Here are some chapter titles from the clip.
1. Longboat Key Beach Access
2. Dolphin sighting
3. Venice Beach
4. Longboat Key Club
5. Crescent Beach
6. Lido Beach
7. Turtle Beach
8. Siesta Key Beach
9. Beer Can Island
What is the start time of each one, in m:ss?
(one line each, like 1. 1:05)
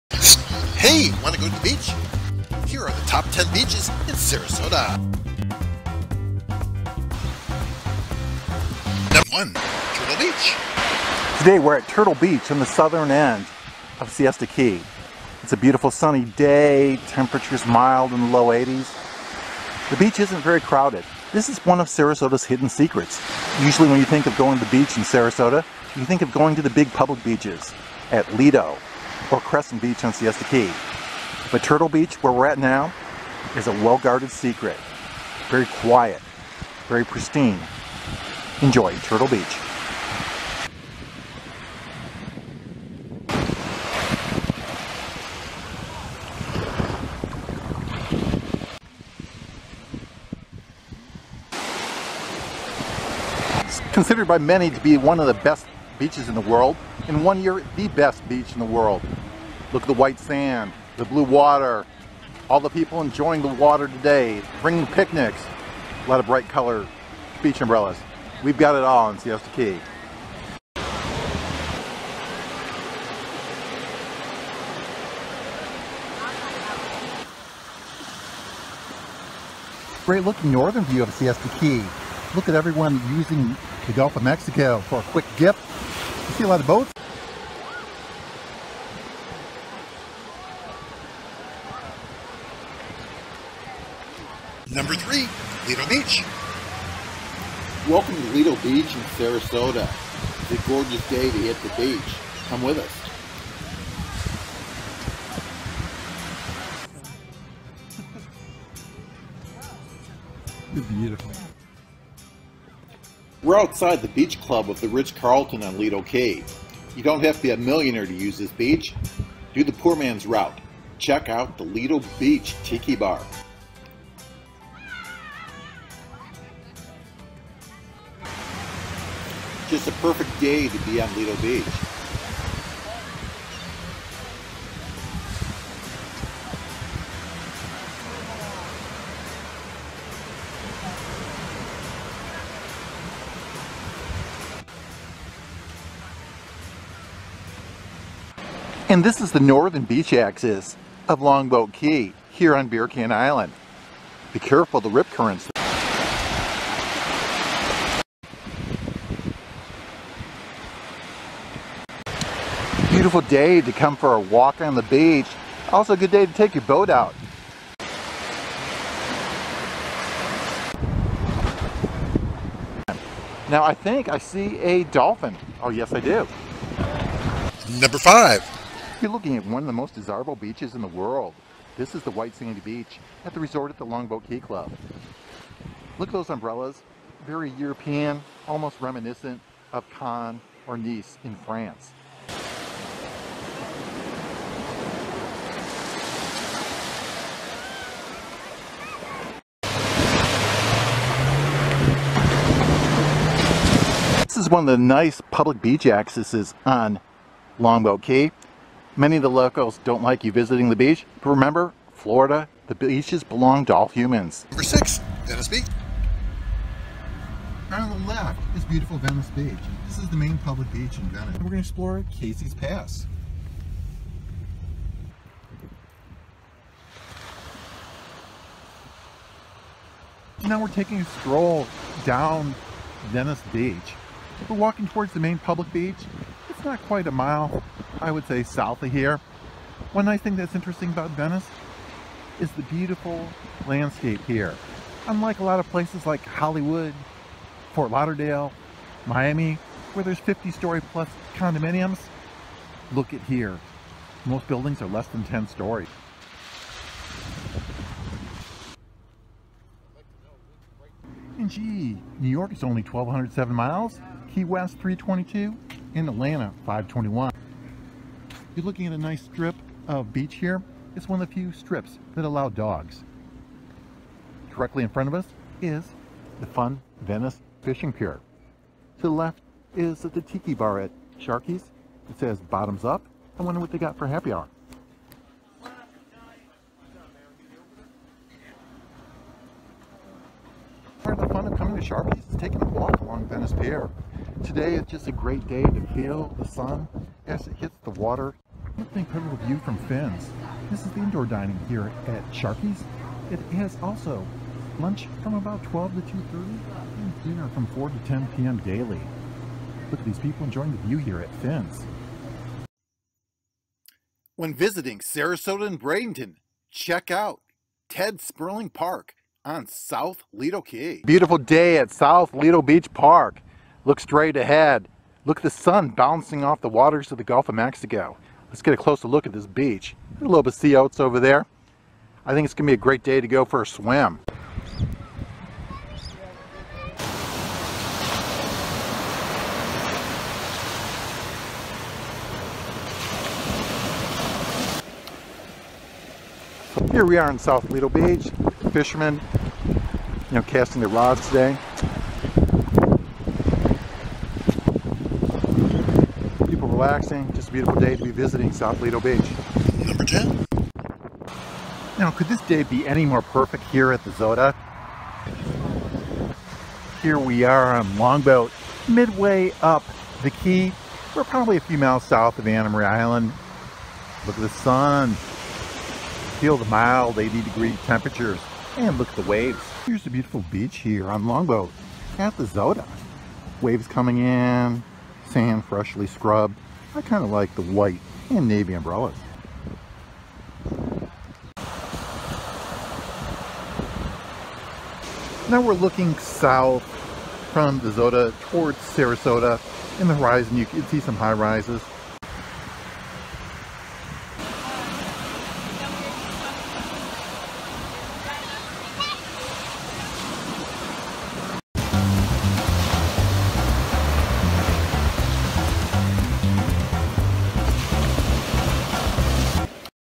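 1. 3:24
2. 2:51
3. 3:35
4. 3:01
5. 0:54
6. 1:35
7. 0:10
8. 1:10
9. 2:28.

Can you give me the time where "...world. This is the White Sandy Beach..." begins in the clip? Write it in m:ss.
3:00.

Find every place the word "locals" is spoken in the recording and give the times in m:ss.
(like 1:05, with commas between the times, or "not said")
3:29.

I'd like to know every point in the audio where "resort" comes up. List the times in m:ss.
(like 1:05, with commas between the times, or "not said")
3:03.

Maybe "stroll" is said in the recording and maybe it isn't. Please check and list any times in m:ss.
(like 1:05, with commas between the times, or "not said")
3:51.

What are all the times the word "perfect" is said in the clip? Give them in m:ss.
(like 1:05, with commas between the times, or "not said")
2:10, 6:03.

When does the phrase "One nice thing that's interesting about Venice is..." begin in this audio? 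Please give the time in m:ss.
3:59.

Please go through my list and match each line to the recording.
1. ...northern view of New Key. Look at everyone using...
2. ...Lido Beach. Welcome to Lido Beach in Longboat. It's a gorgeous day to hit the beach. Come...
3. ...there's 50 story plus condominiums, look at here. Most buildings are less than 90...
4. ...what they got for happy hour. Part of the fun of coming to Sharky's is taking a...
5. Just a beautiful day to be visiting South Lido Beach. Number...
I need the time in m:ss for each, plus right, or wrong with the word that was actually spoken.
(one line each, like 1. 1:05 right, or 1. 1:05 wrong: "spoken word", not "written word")
1. 1:20 wrong: "Siesta", not "New"
2. 1:35 wrong: "Sarasota", not "Longboat"
3. 4:10 wrong: "10", not "90"
4. 4:43 right
5. 5:57 right.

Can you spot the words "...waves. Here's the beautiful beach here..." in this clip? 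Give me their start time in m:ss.
6:19.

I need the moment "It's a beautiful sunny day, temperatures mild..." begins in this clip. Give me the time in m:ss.
0:15.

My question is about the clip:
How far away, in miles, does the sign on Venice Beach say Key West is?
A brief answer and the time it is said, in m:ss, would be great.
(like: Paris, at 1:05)
322, at 4:24.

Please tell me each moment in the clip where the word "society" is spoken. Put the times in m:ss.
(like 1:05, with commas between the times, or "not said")
not said.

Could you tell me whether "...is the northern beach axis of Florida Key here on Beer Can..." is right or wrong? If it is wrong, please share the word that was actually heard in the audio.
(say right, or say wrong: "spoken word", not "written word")
wrong: "Longboat", not "Florida".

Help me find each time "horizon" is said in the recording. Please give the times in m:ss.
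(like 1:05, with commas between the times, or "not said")
6:40.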